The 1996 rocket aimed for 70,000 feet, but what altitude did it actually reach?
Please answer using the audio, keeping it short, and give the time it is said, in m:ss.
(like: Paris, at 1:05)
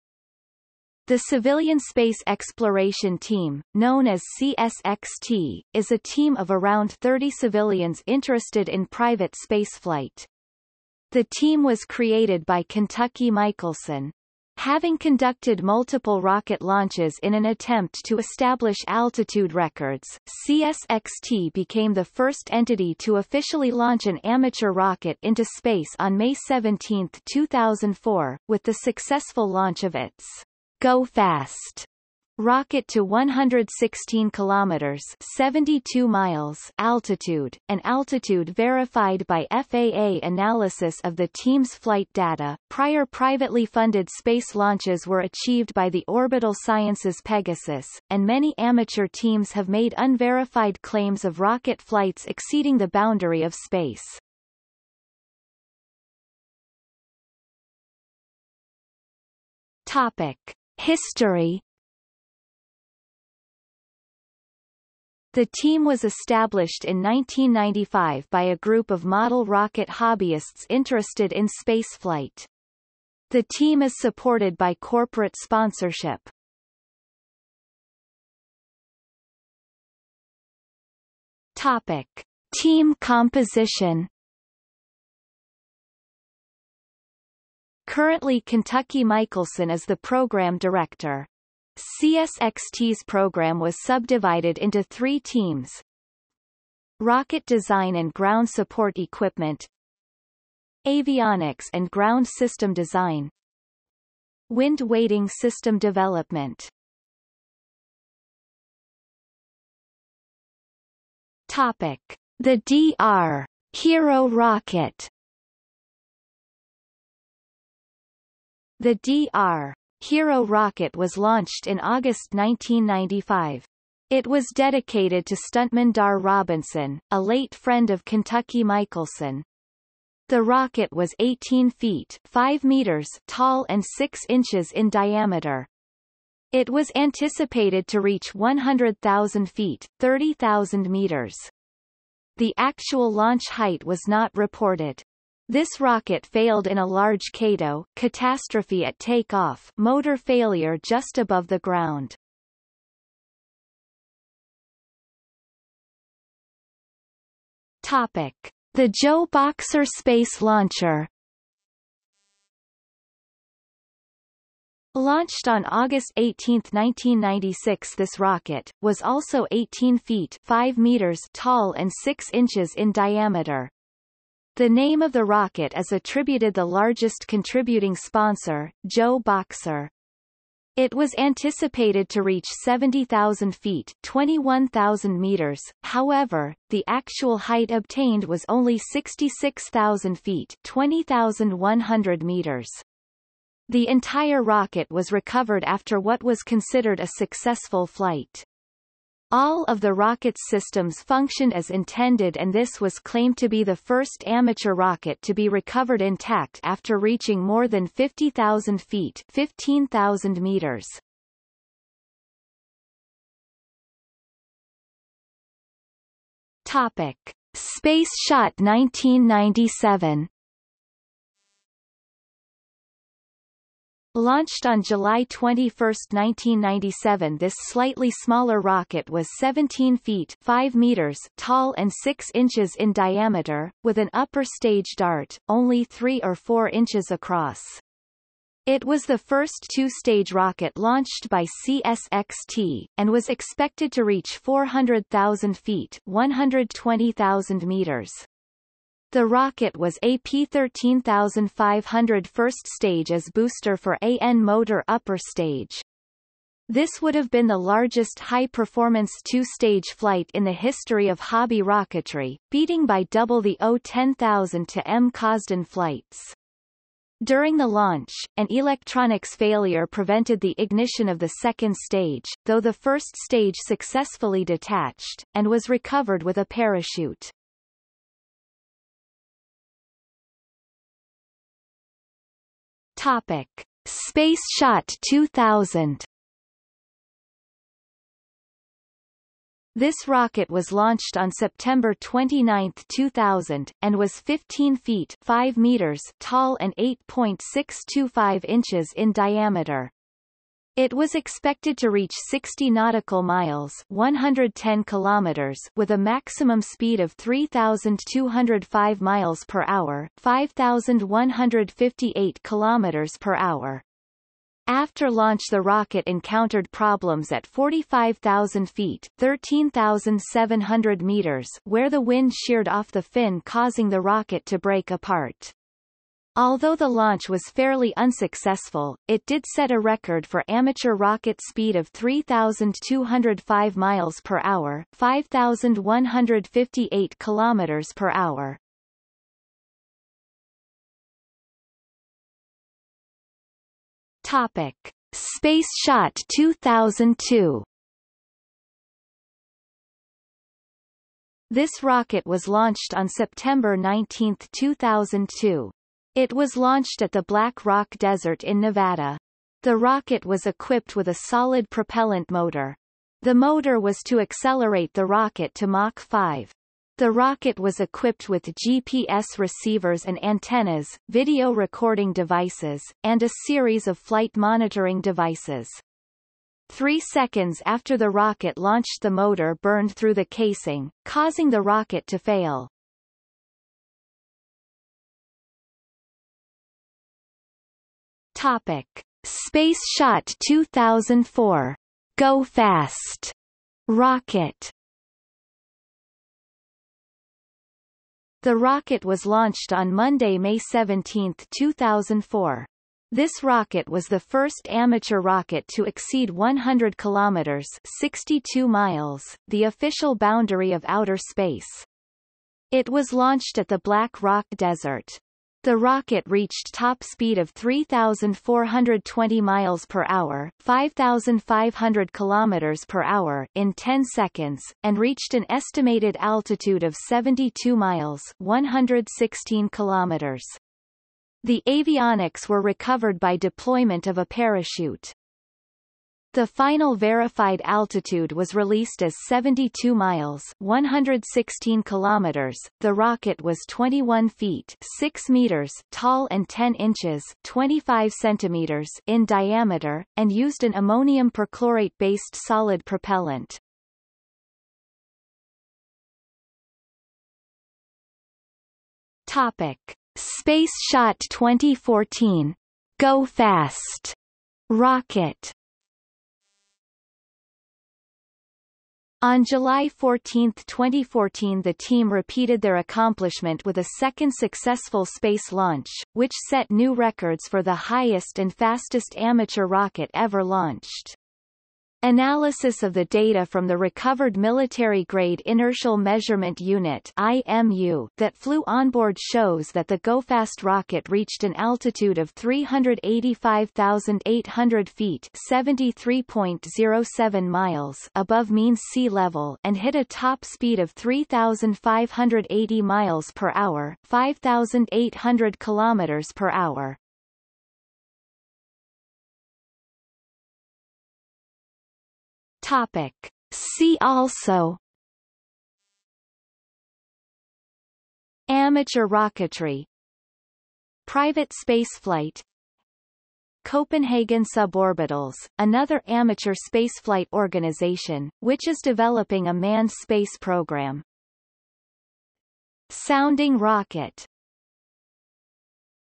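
66,000 feet, at 3:08.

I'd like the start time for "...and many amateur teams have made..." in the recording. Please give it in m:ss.
0:48.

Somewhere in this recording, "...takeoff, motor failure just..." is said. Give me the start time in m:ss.
2:28.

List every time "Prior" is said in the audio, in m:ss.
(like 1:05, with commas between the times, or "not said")
0:42.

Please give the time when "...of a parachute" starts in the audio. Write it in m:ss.
7:14.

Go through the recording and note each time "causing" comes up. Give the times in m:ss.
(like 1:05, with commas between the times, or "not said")
5:23, 6:21.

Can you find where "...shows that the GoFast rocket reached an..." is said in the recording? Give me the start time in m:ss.
8:09.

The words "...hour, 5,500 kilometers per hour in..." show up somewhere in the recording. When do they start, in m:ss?
7:00.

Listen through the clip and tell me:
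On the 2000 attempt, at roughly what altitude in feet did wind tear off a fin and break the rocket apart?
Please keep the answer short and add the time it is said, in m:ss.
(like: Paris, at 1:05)
45,000 feet, at 5:17.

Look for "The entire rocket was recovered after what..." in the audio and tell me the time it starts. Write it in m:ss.
3:13.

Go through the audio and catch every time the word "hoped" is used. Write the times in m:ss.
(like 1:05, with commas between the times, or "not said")
not said.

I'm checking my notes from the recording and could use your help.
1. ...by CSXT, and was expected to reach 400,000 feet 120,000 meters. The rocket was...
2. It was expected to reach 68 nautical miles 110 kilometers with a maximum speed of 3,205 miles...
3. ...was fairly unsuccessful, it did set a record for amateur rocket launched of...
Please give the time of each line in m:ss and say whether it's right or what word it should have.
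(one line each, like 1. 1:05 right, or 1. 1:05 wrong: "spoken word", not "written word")
1. 4:01 right
2. 5:00 wrong: "60", not "68"
3. 5:27 wrong: "speed", not "launched".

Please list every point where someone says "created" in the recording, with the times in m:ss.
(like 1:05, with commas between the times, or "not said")
0:11.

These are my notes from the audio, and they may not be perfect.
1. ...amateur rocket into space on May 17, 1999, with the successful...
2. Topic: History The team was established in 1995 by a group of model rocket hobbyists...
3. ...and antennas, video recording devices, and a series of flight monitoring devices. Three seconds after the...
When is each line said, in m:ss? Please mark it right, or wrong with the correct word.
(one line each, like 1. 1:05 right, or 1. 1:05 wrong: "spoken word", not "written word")
1. 0:24 wrong: "2004", not "1999"
2. 0:59 right
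3. 6:10 right.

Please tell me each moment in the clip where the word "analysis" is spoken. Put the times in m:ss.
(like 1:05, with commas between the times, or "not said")
0:40, 8:02.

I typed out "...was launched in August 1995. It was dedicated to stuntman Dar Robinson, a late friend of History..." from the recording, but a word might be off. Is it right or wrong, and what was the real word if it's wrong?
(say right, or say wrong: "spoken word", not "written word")
wrong: "Kentucky", not "History".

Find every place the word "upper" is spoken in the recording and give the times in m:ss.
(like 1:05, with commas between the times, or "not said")
3:54, 4:14.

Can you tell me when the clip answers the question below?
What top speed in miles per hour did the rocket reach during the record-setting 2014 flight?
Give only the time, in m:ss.
8:20.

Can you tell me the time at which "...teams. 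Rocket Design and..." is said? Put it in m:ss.
1:35.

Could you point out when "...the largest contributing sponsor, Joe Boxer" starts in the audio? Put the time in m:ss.
2:56.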